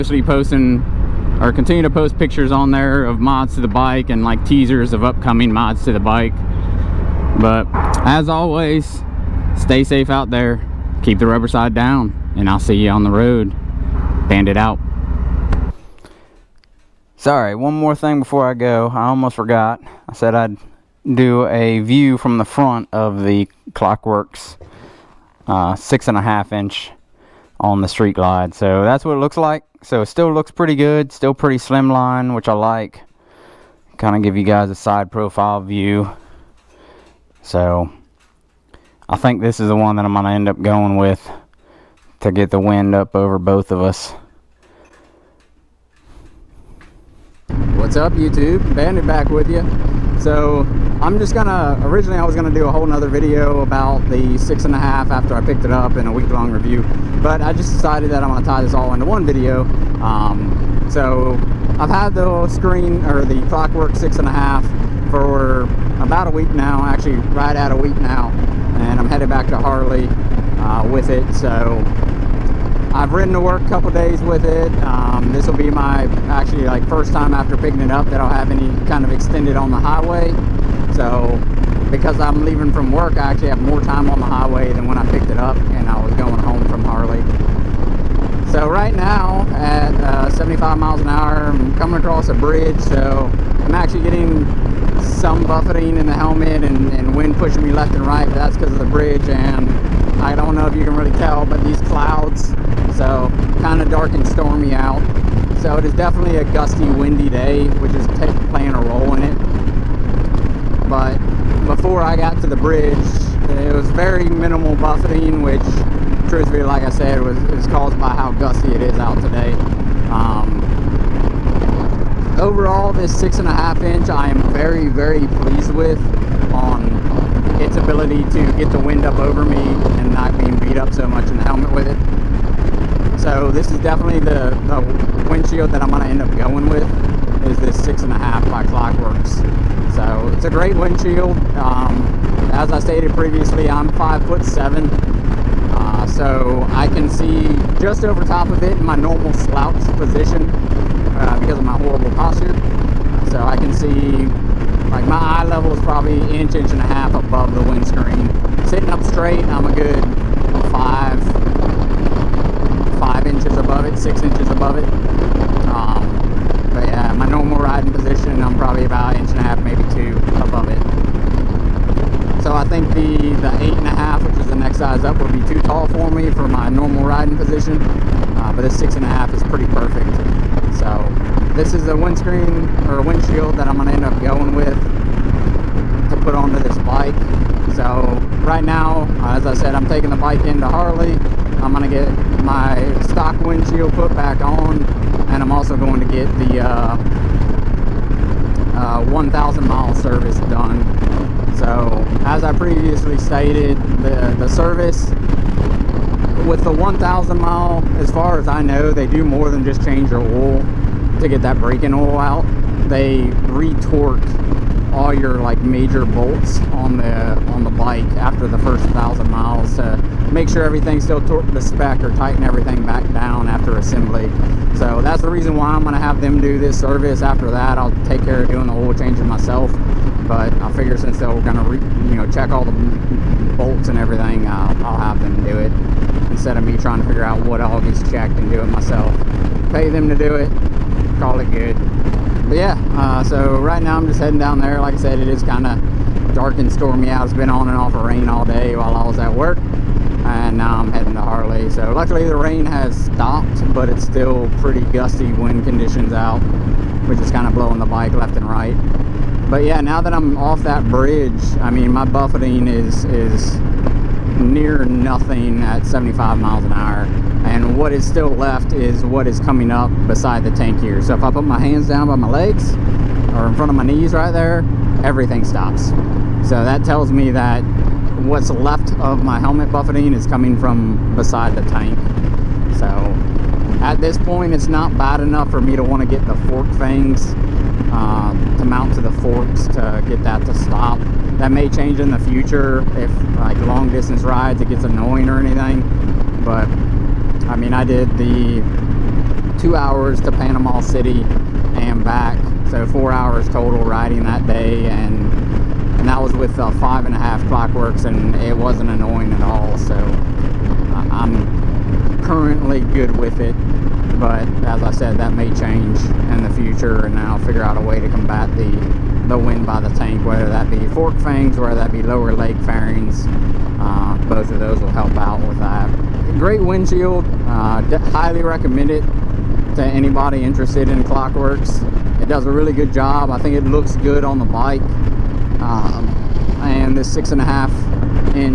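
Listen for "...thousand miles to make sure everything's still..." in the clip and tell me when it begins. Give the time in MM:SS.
03:38.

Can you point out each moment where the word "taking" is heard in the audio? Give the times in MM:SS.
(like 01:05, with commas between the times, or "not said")
03:09.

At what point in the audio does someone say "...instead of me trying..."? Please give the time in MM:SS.
03:56.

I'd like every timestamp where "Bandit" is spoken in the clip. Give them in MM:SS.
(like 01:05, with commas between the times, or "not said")
00:14, 00:48.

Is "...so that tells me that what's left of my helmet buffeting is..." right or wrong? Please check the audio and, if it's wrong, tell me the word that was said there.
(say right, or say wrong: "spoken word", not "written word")
right.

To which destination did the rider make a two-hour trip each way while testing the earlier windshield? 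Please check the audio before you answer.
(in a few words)
Panama City.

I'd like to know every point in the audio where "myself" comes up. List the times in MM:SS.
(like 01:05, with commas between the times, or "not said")
03:49, 03:58.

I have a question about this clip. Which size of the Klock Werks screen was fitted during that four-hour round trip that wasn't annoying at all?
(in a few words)
5 and a half.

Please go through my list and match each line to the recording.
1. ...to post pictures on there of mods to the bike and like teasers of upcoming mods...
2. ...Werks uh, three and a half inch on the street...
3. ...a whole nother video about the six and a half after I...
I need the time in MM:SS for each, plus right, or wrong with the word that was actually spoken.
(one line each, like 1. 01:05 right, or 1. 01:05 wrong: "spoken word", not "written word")
1. 00:01 right
2. 00:24 wrong: "six", not "three"
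3. 00:52 right.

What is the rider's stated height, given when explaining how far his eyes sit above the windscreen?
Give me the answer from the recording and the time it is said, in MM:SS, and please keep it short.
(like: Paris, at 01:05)
5 foot 7, at 02:23.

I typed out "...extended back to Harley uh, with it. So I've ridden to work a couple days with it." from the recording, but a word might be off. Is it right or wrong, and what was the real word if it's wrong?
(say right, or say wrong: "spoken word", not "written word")
wrong: "headed", not "extended".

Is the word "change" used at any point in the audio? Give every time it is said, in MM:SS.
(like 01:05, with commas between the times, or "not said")
03:29, 03:48, 04:51, 05:15.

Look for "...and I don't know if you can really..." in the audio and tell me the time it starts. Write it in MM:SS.
01:39.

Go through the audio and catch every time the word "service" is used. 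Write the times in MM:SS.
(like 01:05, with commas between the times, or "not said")
03:19, 03:24, 03:46.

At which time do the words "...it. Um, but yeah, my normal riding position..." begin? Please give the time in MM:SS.
02:44.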